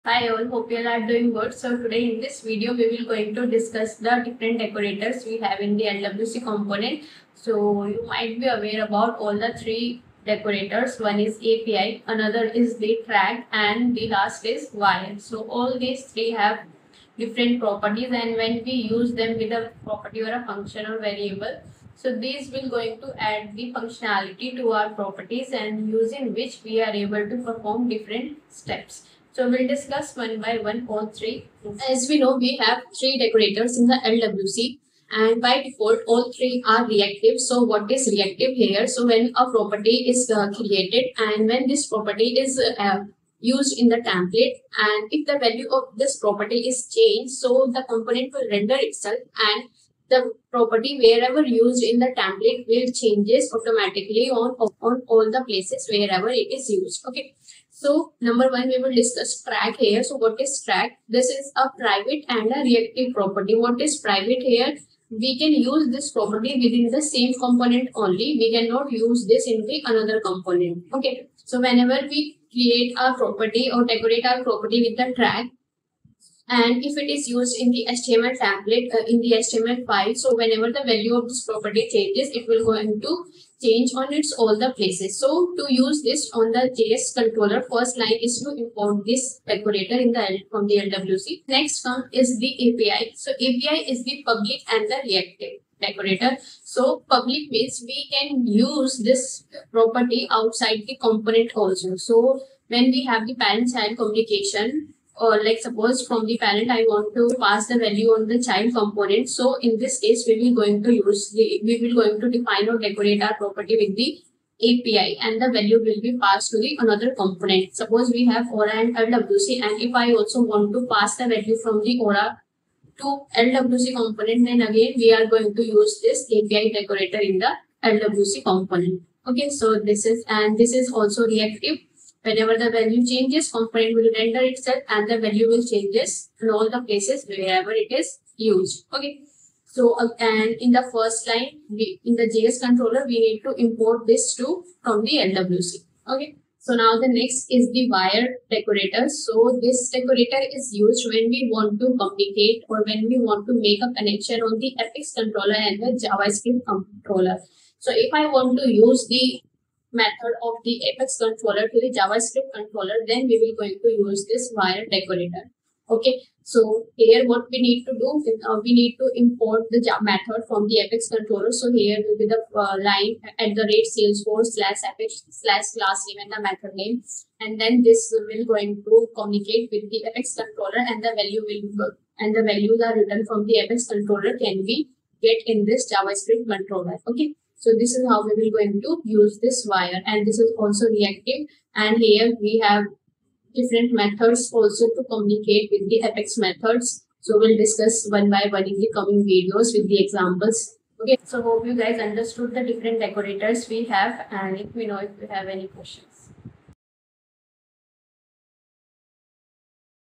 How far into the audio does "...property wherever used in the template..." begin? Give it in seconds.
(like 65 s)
50 s.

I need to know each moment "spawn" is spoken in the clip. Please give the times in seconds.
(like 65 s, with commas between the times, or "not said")
not said.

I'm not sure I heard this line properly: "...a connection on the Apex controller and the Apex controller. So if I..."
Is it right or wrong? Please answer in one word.
wrong.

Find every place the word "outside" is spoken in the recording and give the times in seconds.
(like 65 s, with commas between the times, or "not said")
100 s.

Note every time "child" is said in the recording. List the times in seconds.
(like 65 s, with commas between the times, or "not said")
103 s, 108 s.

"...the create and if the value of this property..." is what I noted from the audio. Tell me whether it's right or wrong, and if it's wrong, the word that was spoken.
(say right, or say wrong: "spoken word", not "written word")
wrong: "template", not "create".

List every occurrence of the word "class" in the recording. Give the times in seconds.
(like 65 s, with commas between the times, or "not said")
175 s.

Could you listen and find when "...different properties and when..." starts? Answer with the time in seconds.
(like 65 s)
17 s.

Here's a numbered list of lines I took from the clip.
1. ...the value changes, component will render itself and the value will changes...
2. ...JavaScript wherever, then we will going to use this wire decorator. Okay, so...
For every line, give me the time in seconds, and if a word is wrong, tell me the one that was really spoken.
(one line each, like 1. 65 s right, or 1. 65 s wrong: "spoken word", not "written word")
1. 132 s right
2. 161 s wrong: "controller", not "wherever".